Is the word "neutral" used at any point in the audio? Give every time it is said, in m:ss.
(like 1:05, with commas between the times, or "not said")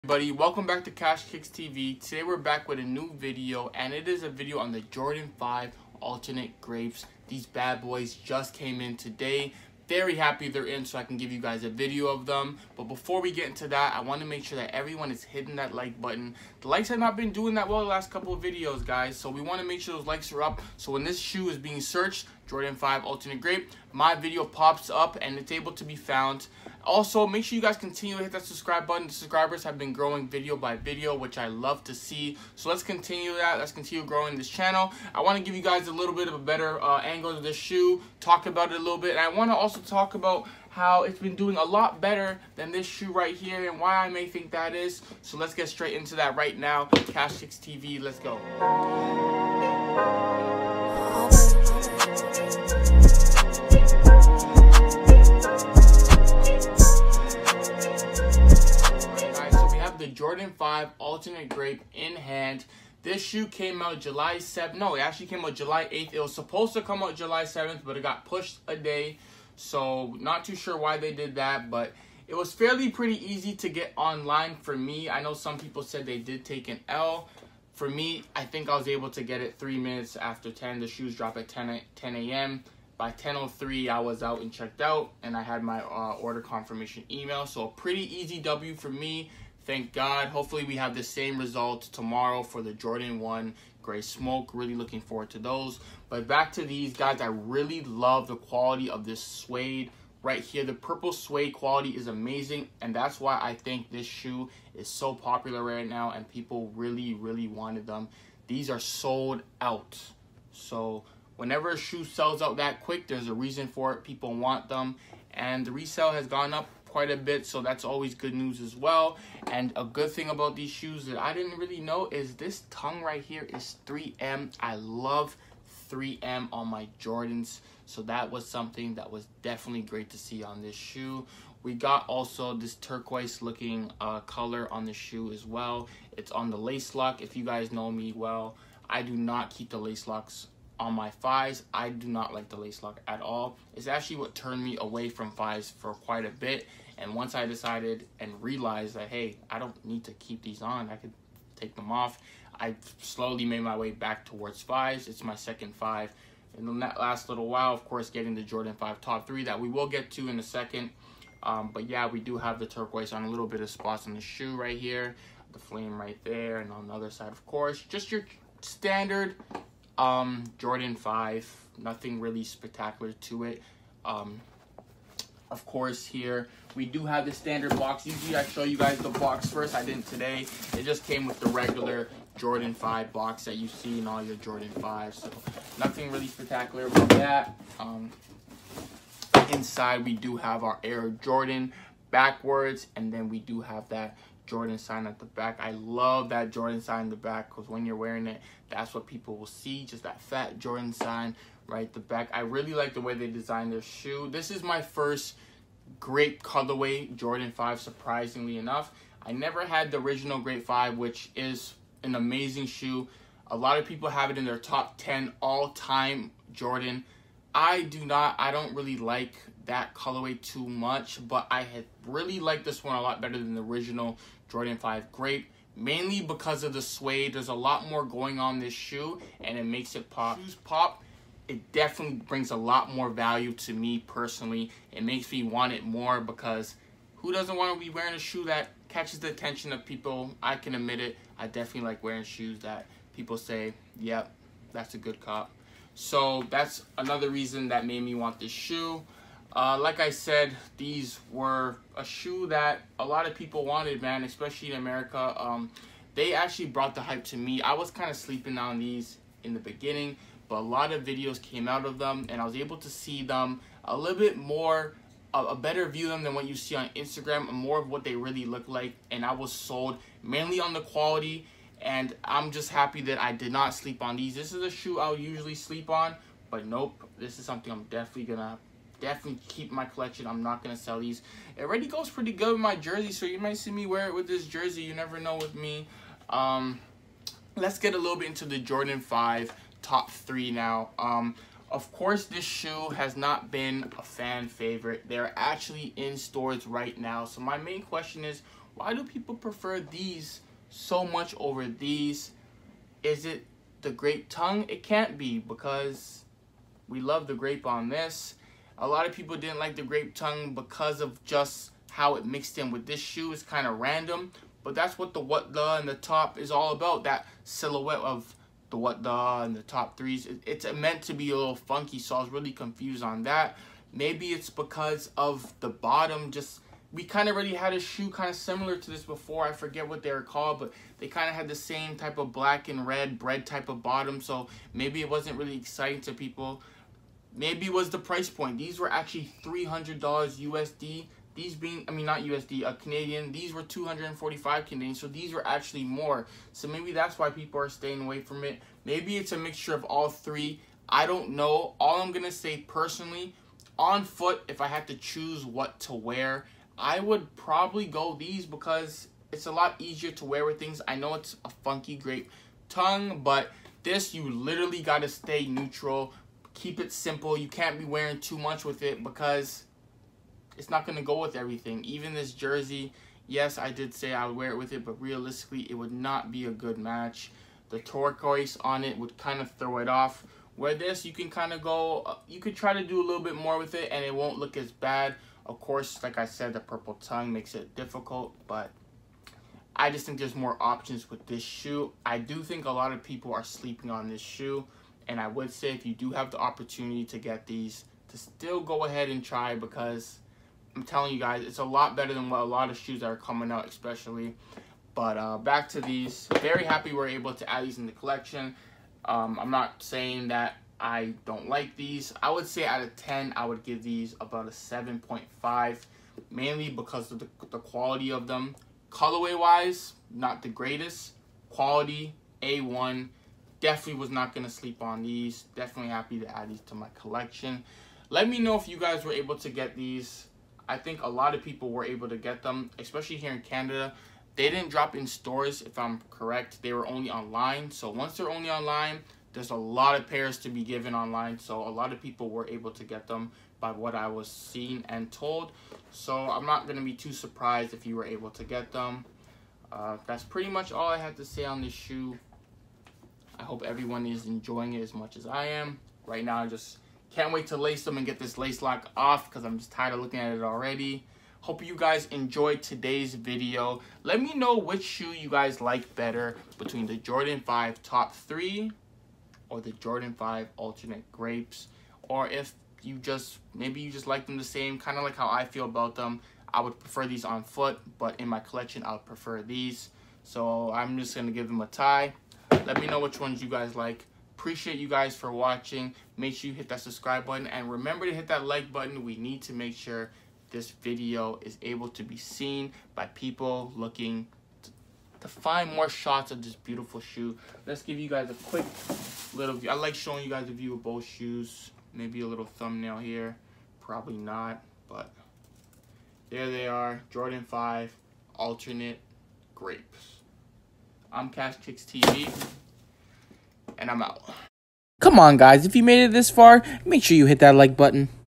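6:05.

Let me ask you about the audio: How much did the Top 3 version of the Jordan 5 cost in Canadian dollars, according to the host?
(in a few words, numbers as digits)
$300.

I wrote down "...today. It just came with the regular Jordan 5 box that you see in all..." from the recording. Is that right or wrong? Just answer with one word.
right.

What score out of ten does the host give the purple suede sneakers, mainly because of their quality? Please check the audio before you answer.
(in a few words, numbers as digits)
7.5.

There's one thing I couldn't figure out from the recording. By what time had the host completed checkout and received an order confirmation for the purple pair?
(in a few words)
10:03.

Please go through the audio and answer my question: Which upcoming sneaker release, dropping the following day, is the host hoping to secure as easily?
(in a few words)
Jordan 1 Gray Smoke.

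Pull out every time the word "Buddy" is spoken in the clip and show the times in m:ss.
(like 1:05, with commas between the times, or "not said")
0:00.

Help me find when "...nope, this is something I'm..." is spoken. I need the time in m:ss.
4:36.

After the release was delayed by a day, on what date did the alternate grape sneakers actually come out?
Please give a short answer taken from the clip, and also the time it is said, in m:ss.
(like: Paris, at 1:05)
July 8th, at 1:05.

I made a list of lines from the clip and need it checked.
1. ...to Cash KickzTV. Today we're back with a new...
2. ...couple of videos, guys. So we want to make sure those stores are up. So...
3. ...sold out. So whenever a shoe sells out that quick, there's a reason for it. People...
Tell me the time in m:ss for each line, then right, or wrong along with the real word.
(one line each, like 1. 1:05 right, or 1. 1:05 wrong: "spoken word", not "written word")
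1. 0:00 right
2. 0:18 wrong: "likes", not "stores"
3. 1:48 right.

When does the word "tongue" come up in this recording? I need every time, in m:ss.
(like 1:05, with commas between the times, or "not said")
2:02, 5:04, 5:10, 6:02, 6:26.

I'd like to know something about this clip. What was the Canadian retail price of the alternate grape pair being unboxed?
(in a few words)
245 Canadian.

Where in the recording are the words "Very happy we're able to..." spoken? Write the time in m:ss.
6:46.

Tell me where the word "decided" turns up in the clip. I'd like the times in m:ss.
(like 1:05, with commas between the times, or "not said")
2:27.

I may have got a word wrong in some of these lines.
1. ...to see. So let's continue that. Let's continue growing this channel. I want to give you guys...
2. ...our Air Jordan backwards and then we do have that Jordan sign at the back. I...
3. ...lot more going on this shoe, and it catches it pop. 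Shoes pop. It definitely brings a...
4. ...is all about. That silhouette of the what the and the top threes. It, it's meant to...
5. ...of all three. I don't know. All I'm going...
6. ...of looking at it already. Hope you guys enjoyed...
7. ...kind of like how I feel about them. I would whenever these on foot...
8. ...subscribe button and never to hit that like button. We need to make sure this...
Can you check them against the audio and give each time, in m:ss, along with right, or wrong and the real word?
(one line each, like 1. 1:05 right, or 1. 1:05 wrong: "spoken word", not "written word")
1. 0:31 right
2. 3:10 right
3. 3:47 wrong: "makes", not "catches"
4. 5:16 right
5. 5:49 right
6. 7:39 right
7. 7:54 wrong: "prefer", not "whenever"
8. 8:06 wrong: "remember", not "never".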